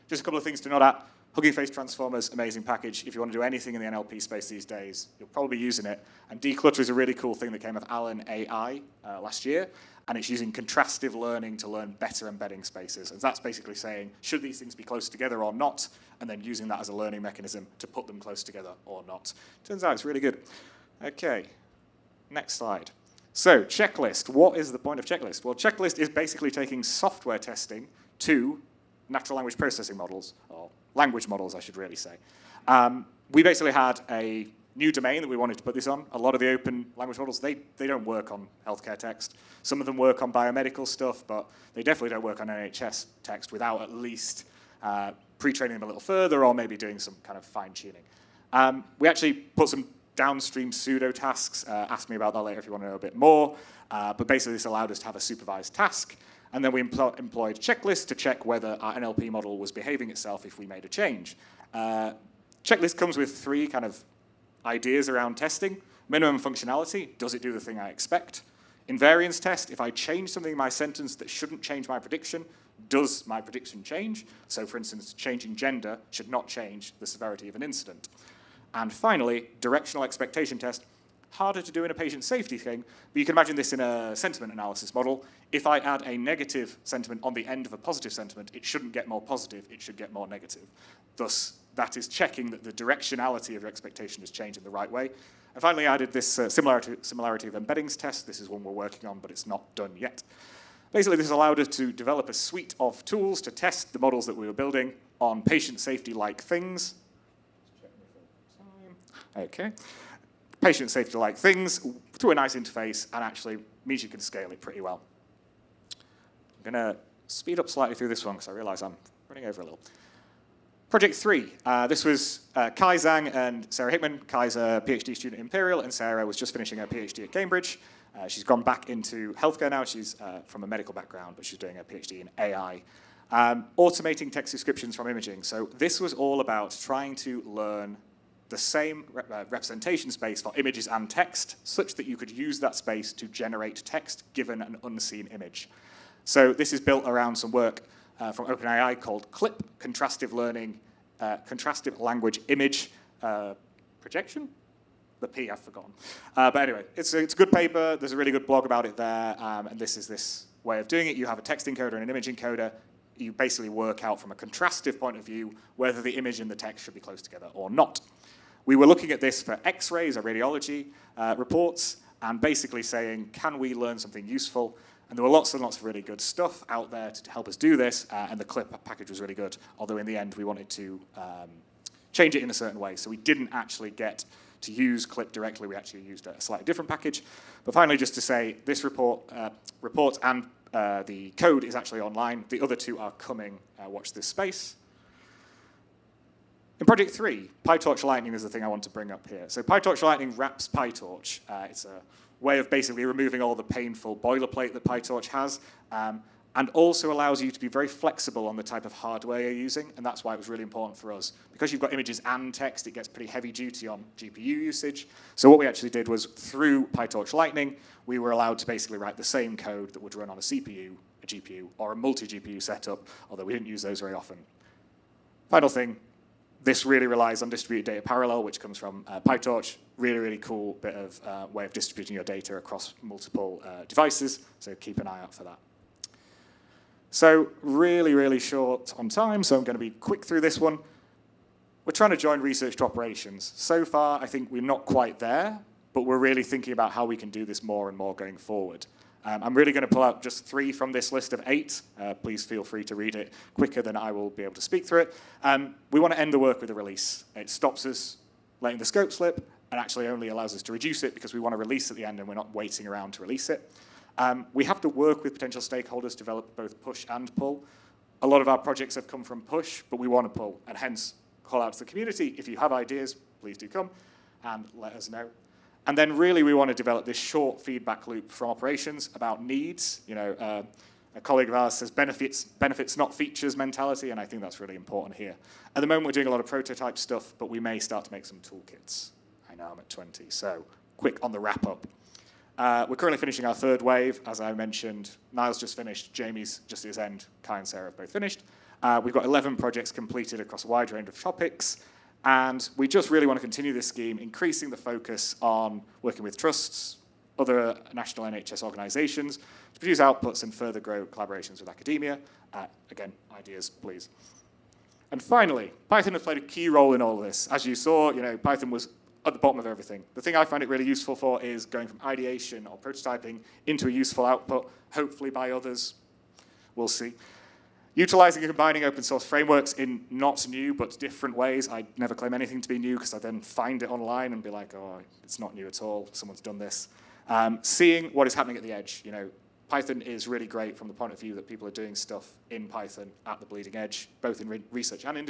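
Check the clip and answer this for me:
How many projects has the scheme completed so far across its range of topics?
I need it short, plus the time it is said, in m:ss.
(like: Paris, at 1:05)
11, at 4:59.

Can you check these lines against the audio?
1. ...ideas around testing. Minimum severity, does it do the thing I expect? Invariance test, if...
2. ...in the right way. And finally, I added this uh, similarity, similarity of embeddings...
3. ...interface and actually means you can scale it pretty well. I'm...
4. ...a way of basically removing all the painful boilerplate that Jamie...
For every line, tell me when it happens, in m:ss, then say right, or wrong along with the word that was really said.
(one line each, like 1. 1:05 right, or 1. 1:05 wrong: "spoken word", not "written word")
1. 1:04 wrong: "functionality", not "severity"
2. 1:34 right
3. 1:52 right
4. 3:21 wrong: "PyTorch", not "Jamie".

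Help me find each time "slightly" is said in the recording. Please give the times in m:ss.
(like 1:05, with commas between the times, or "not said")
1:57, 3:06.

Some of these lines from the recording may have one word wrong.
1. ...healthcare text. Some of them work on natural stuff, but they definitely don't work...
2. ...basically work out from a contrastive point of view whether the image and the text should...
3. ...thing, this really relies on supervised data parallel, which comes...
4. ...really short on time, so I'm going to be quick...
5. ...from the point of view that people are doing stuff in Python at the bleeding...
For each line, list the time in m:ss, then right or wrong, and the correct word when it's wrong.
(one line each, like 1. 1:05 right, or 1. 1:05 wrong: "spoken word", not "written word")
1. 0:38 wrong: "biomedical", not "natural"
2. 2:43 right
3. 3:45 wrong: "distributed", not "supervised"
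4. 3:58 right
5. 5:40 right.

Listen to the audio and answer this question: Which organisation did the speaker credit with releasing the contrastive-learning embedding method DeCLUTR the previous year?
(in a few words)
Allen AI.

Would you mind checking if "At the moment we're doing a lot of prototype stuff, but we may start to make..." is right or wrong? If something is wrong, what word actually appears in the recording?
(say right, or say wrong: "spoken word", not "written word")
right.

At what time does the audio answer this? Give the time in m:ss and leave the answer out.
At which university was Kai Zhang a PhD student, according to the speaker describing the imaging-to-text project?
2:05.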